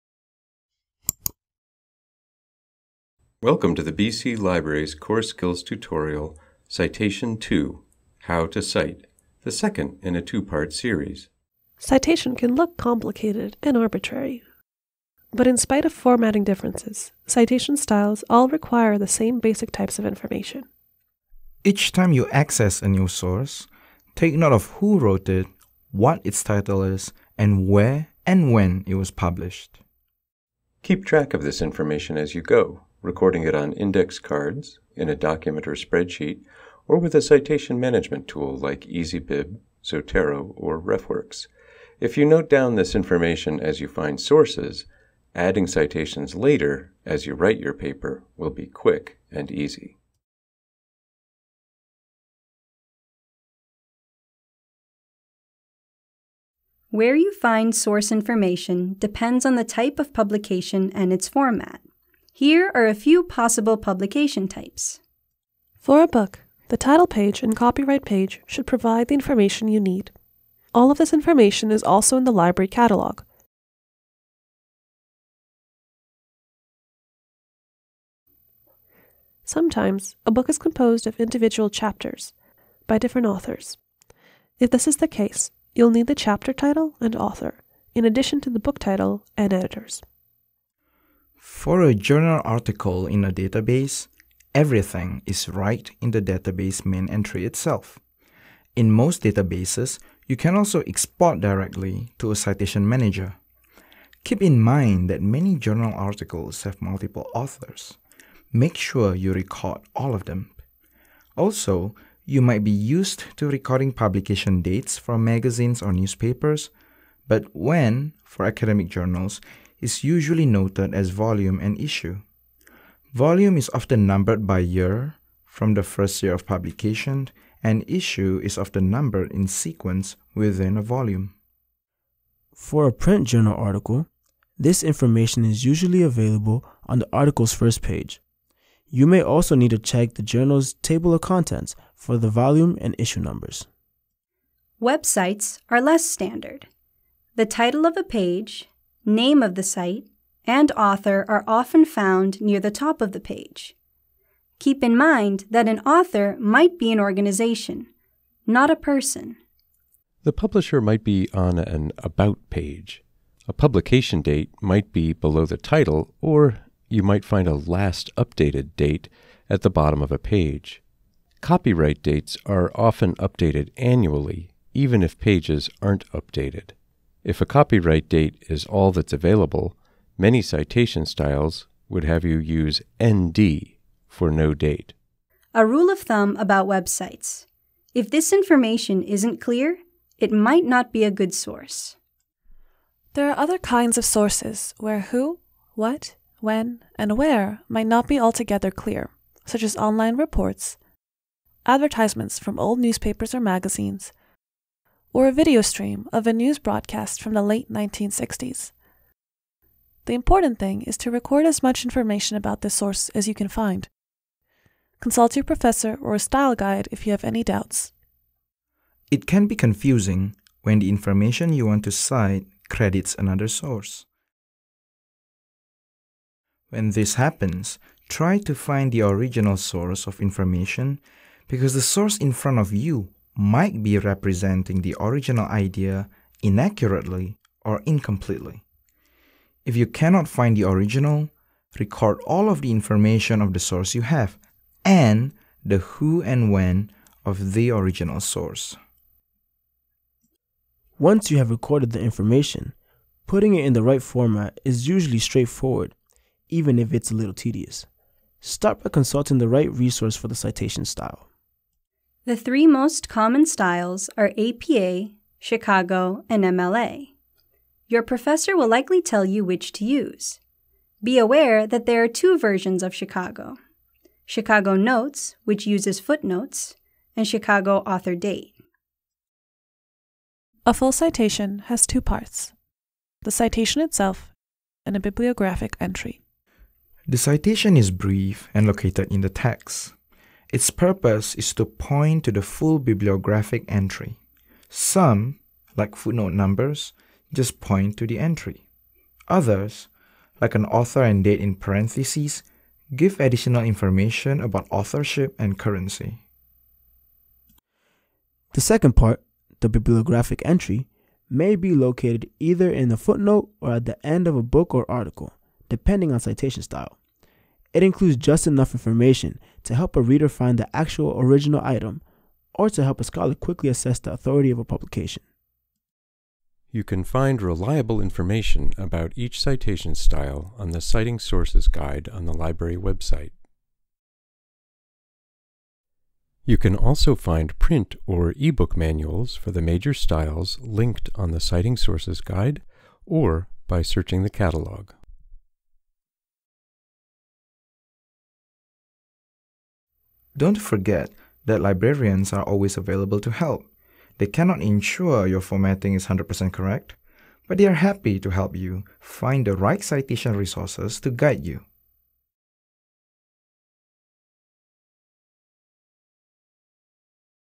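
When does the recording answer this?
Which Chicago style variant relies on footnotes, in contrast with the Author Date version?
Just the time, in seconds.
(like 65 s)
274 s.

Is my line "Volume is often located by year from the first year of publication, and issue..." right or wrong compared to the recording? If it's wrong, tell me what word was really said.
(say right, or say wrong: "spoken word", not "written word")
wrong: "numbered", not "located".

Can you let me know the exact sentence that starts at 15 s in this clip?
But in spite of formatting differences, citation styles all require the same basic types of information.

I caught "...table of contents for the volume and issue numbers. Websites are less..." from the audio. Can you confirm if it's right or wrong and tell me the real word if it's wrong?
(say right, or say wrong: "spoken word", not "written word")
right.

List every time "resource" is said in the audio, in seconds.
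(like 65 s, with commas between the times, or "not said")
259 s, 360 s.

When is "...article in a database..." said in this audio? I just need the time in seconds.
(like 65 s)
92 s.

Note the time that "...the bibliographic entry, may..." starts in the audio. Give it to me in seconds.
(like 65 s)
309 s.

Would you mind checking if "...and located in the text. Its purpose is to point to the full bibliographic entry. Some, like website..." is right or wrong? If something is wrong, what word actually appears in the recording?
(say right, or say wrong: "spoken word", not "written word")
wrong: "footnote", not "website".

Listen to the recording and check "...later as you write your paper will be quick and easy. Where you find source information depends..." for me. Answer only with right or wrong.
right.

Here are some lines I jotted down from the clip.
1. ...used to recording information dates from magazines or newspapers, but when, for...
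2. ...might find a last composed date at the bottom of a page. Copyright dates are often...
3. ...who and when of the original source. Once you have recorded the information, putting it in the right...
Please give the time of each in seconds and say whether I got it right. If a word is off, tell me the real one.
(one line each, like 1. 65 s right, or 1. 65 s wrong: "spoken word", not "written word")
1. 112 s wrong: "publication", not "information"
2. 167 s wrong: "updated", not "composed"
3. 245 s right.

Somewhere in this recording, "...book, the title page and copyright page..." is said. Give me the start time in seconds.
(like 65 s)
66 s.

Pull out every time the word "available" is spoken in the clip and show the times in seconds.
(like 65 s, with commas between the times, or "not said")
136 s, 179 s, 352 s.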